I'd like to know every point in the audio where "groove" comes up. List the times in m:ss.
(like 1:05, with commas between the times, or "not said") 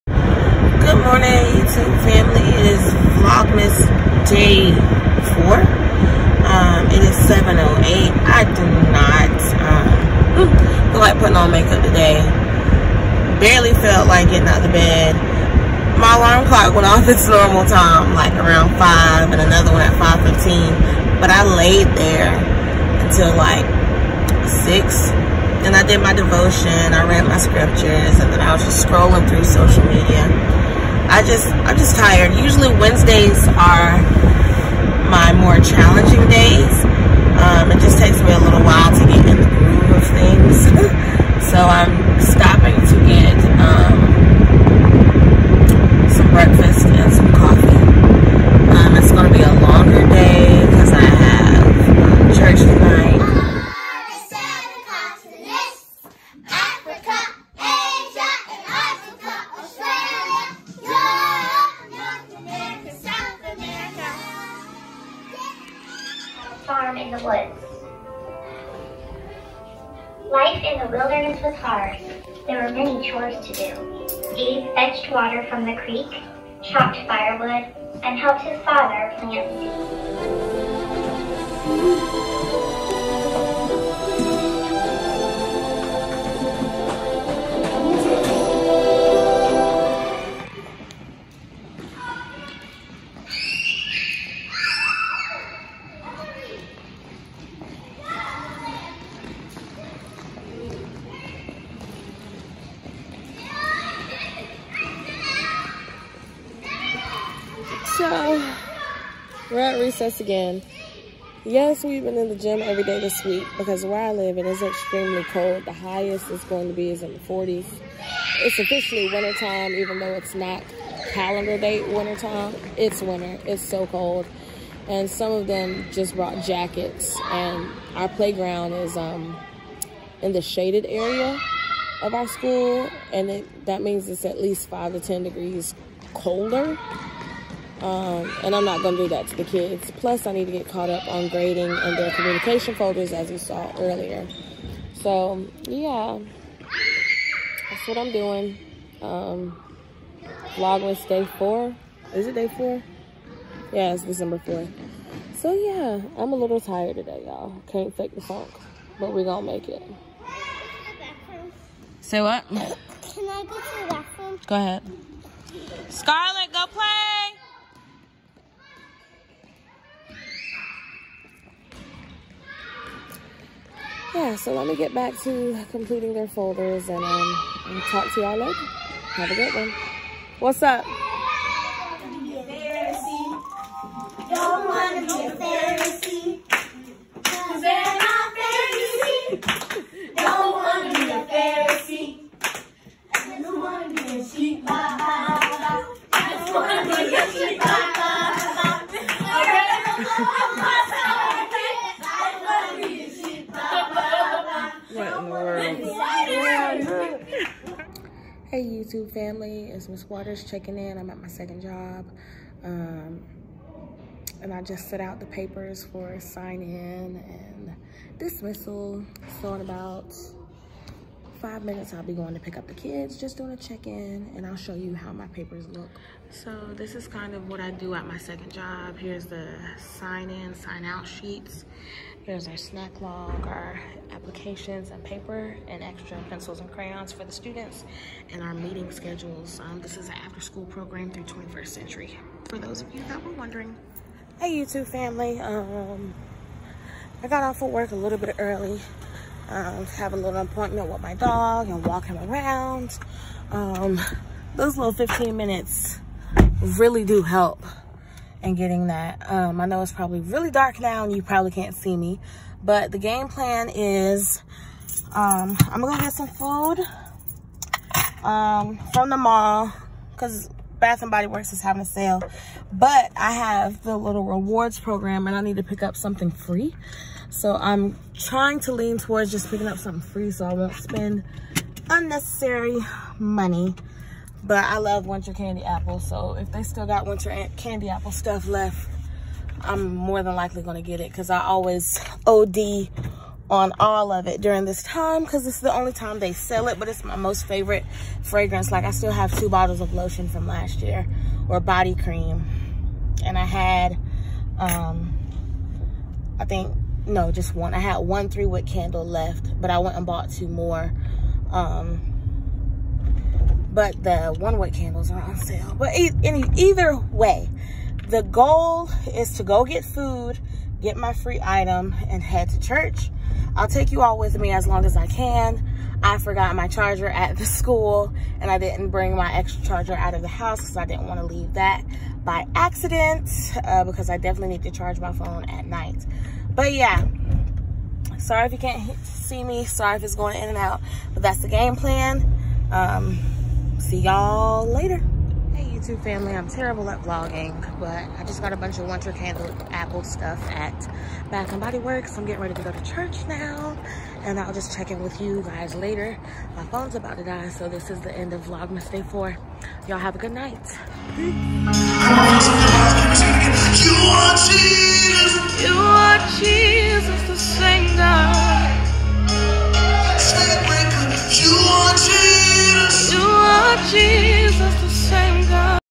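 0:39.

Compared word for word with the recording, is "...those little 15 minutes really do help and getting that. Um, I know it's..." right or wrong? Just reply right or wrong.
right.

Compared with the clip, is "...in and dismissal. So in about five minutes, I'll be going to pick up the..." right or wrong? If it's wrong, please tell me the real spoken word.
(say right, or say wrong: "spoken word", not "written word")
right.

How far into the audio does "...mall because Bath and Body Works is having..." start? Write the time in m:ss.
4:29.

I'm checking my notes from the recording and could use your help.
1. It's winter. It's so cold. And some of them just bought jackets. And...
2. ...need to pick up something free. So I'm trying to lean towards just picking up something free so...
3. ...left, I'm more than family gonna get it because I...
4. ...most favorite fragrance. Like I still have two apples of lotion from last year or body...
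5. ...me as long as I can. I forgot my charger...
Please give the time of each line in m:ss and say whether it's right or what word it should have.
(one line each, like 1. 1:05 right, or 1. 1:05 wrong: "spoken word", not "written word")
1. 2:02 wrong: "brought", not "bought"
2. 4:35 right
3. 4:48 wrong: "likely", not "family"
4. 4:57 wrong: "bottles", not "apples"
5. 5:24 right.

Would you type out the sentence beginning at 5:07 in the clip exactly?
I had one three-wick candle left, but I went and bought two more.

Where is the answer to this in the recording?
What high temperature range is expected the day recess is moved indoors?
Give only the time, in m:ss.
1:57.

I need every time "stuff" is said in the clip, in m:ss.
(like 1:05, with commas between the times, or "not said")
4:48, 5:50.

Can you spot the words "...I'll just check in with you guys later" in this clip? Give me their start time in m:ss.
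5:54.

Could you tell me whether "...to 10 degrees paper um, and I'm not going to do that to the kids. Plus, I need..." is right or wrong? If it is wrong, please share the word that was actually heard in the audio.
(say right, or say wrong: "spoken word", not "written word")
wrong: "colder", not "paper".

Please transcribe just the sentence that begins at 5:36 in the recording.
But yeah, sorry if you can't see me.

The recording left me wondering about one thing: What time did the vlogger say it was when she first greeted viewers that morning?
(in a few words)
7:08.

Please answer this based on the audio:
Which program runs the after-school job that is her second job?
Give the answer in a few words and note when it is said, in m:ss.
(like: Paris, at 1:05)
21st century, at 4:01.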